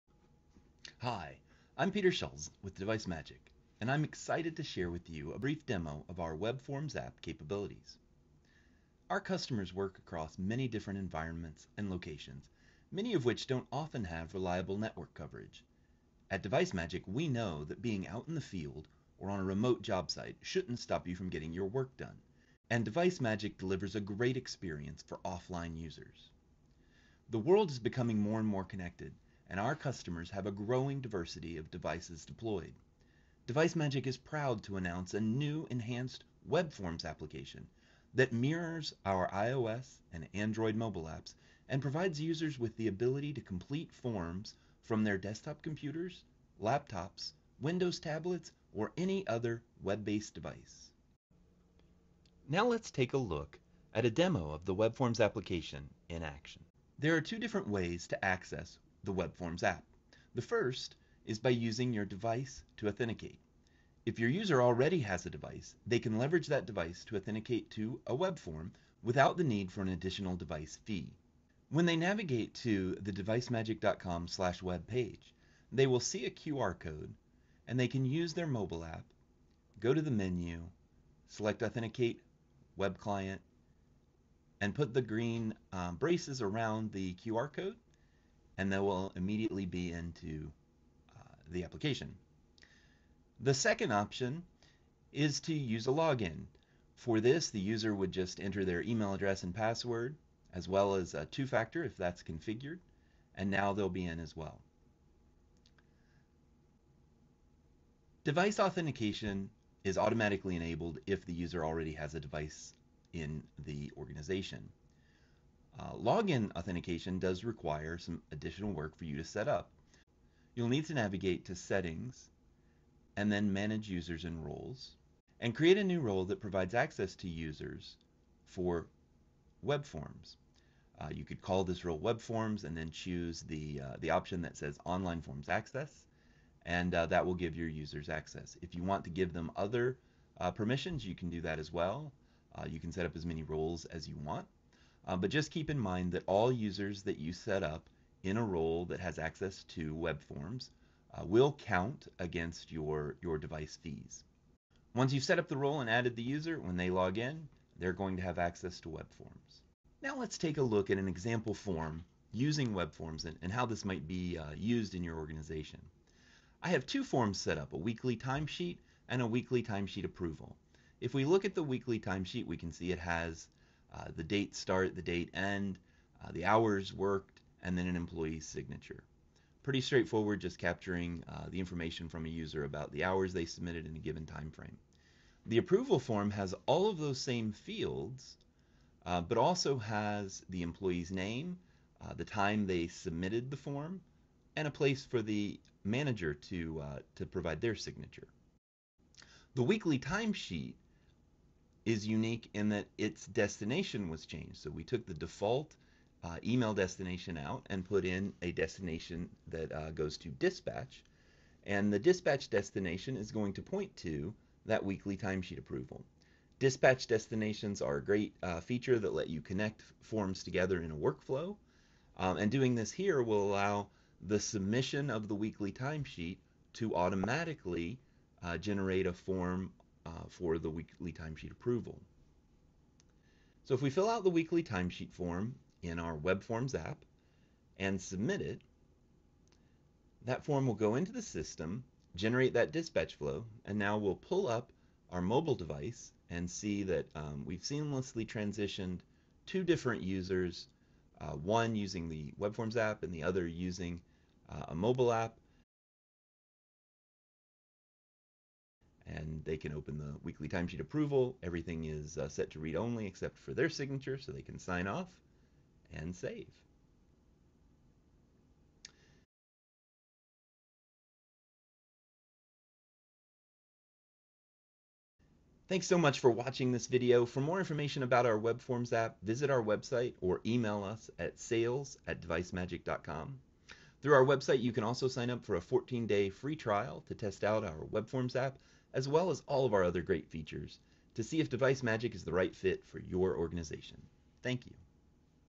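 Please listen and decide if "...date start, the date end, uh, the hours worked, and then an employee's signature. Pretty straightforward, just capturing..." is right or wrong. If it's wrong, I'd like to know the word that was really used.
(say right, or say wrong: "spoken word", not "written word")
right.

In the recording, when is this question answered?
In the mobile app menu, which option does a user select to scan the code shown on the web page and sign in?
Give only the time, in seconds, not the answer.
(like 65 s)
81 s.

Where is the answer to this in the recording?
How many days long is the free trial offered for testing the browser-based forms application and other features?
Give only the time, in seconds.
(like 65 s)
285 s.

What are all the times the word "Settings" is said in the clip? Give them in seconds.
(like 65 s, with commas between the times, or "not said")
121 s.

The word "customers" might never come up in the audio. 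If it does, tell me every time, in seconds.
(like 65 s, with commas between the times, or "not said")
9 s, 29 s.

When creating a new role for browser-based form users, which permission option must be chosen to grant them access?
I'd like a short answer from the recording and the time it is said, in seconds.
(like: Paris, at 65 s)
online forms access, at 134 s.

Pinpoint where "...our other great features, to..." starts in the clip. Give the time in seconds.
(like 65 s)
289 s.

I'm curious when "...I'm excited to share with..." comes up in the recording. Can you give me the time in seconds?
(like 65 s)
3 s.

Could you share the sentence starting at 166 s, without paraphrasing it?
I have two forms set up, a weekly timesheet and a weekly timesheet approval.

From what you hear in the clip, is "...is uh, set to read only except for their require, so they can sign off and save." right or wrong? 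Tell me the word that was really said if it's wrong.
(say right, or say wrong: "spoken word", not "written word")
wrong: "signature", not "require".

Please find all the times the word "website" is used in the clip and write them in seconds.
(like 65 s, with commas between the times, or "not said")
279 s, 284 s.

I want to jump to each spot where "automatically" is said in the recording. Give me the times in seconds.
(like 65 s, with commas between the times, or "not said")
109 s, 226 s.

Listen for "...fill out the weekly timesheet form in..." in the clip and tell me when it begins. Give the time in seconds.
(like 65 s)
233 s.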